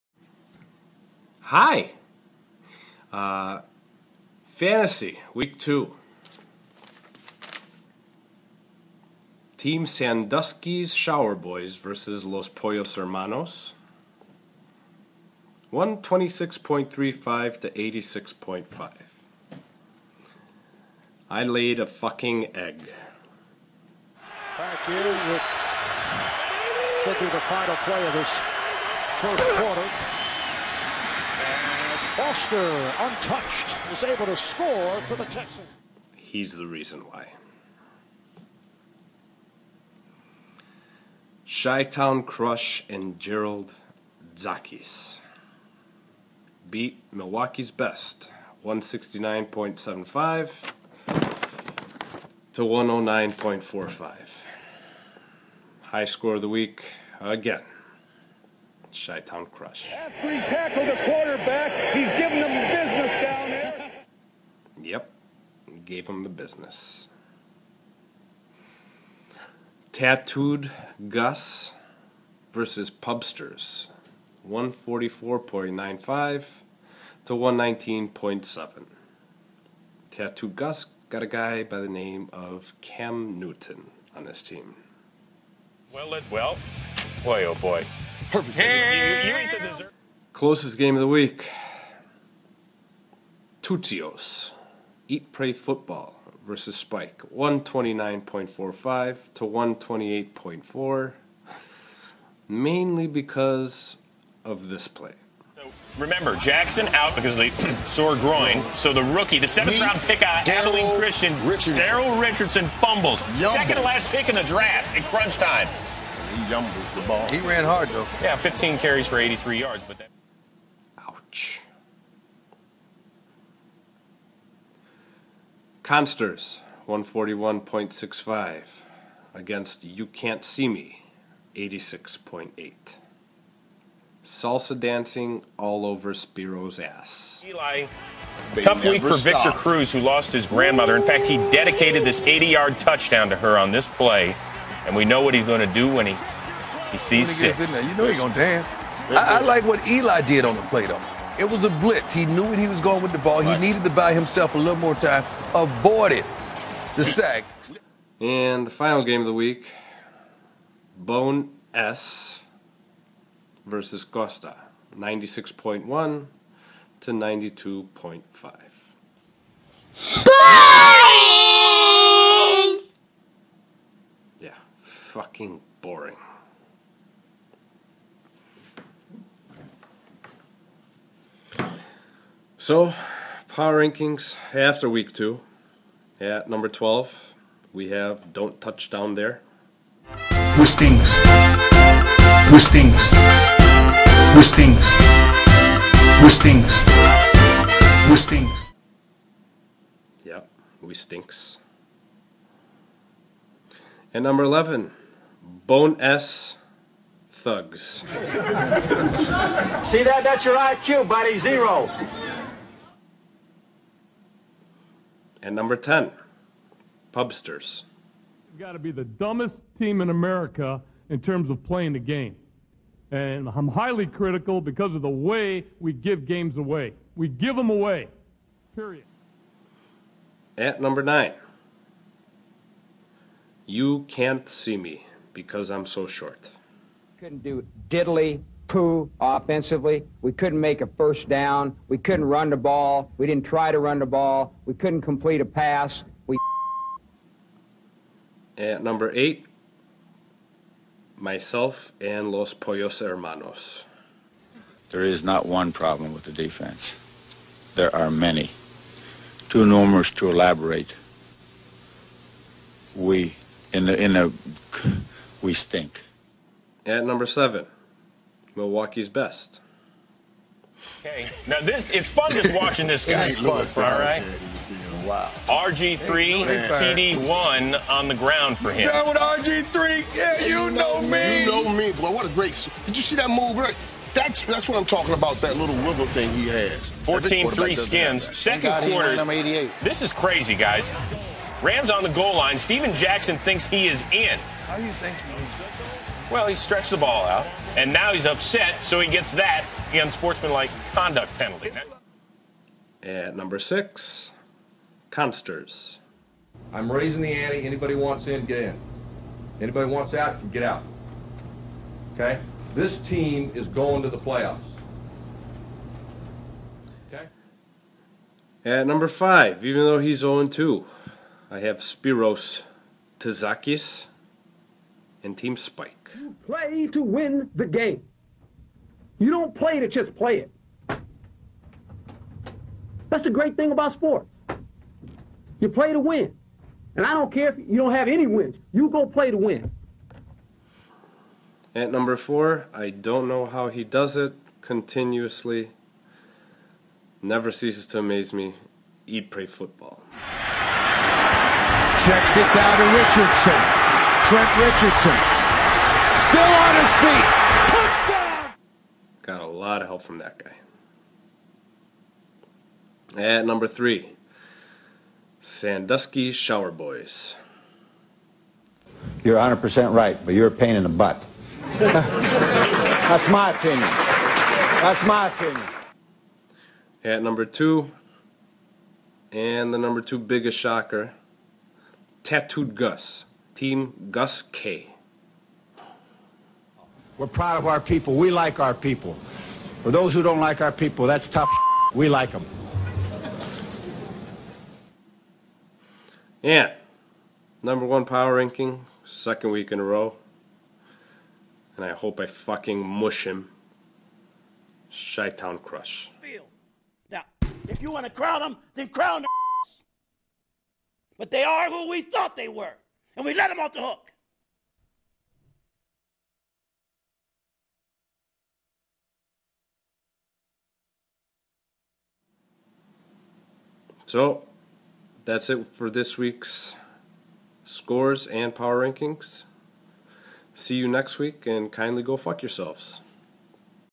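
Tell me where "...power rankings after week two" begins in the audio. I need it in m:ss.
3:03.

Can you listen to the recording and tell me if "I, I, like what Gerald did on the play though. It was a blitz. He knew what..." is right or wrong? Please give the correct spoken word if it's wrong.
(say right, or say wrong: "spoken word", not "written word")
wrong: "Eli", not "Gerald".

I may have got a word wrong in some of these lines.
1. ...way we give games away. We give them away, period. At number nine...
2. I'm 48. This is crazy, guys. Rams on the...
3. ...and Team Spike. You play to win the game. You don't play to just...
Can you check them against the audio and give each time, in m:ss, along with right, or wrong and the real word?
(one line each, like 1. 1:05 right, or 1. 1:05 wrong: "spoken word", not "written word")
1. 3:45 right
2. 4:49 wrong: "88", not "48"
3. 5:25 right.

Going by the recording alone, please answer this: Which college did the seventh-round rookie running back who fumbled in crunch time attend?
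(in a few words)
Abilene Christian.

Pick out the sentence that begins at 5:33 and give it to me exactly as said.
That's the great thing about sports.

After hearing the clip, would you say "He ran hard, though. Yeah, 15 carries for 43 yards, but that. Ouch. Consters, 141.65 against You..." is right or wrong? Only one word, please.
wrong.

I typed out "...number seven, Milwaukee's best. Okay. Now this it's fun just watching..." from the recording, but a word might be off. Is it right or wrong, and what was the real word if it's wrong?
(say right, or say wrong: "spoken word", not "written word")
right.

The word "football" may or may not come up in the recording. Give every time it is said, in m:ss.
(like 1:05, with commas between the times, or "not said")
1:35, 5:49.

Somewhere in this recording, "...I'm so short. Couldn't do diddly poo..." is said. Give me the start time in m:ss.
3:55.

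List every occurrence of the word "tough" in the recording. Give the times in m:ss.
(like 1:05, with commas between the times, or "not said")
2:18, 6:31.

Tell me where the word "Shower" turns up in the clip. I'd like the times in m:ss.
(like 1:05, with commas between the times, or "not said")
0:10, 6:06.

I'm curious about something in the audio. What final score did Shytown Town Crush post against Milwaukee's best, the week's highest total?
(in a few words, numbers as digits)
169.75.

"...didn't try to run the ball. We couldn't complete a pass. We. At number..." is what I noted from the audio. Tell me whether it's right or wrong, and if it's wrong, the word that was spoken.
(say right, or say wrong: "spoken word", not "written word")
right.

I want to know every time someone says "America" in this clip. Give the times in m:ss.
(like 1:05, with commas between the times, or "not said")
3:40.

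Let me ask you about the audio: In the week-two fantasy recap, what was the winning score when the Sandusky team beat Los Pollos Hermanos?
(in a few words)
126.35.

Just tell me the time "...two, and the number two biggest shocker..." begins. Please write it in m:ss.
6:17.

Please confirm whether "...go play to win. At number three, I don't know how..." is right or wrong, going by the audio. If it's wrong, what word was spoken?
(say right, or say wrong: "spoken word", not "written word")
wrong: "four", not "three".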